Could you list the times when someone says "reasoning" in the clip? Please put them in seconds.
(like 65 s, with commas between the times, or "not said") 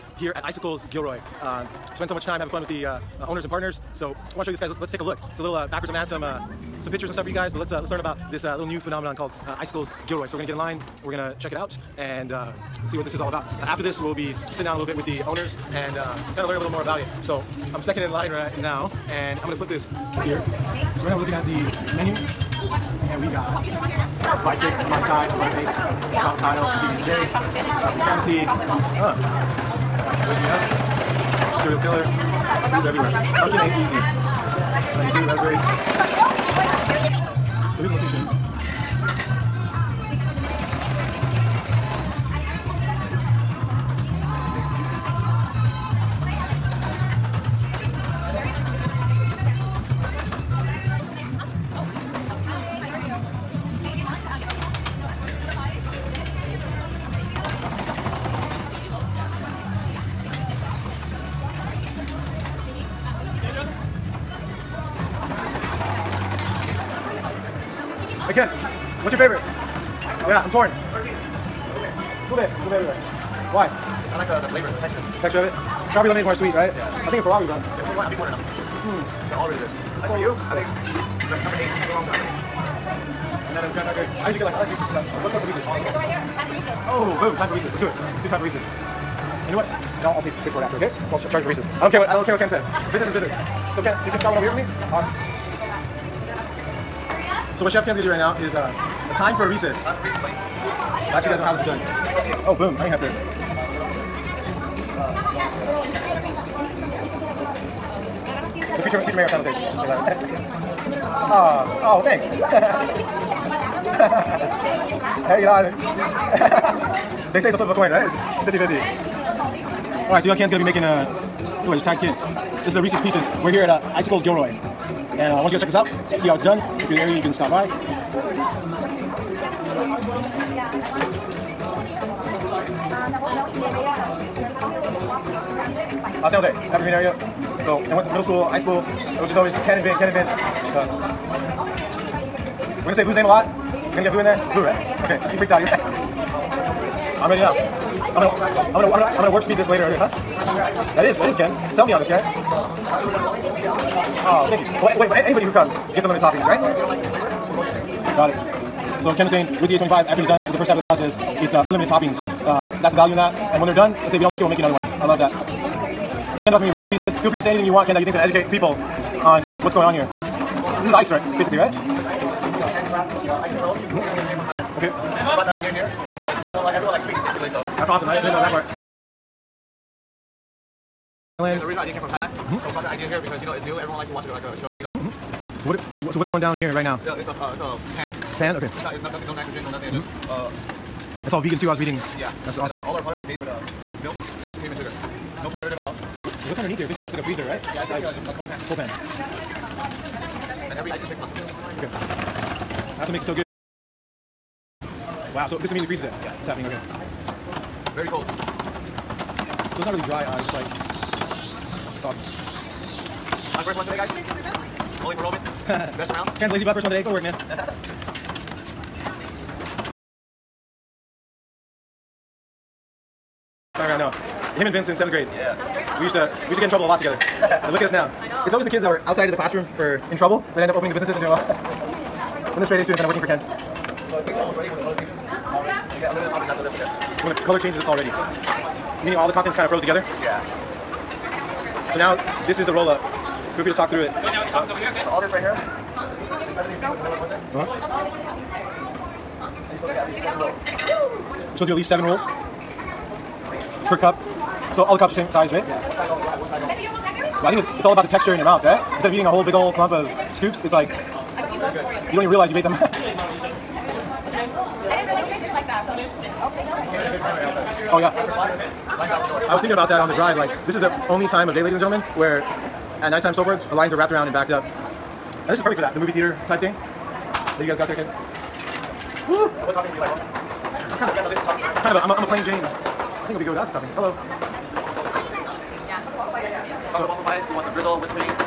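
not said.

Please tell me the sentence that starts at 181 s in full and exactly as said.
Yeah, original idea came from Thailand.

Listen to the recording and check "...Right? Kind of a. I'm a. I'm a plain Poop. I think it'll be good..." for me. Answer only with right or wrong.
wrong.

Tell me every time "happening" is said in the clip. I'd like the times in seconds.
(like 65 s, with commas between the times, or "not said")
206 s, 279 s.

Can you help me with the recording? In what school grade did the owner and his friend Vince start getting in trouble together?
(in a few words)
Seventh grade.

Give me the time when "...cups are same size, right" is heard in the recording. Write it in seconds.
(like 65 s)
254 s.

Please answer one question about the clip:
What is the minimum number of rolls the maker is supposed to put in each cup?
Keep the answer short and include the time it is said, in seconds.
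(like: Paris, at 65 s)
7, at 251 s.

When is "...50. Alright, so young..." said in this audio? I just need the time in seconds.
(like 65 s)
118 s.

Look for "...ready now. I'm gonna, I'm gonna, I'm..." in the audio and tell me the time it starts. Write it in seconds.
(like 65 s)
147 s.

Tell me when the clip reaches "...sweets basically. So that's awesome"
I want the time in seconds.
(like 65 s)
177 s.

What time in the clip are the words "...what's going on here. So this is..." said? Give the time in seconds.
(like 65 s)
169 s.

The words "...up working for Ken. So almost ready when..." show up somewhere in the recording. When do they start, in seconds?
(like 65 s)
233 s.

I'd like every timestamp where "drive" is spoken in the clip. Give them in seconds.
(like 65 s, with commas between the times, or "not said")
270 s.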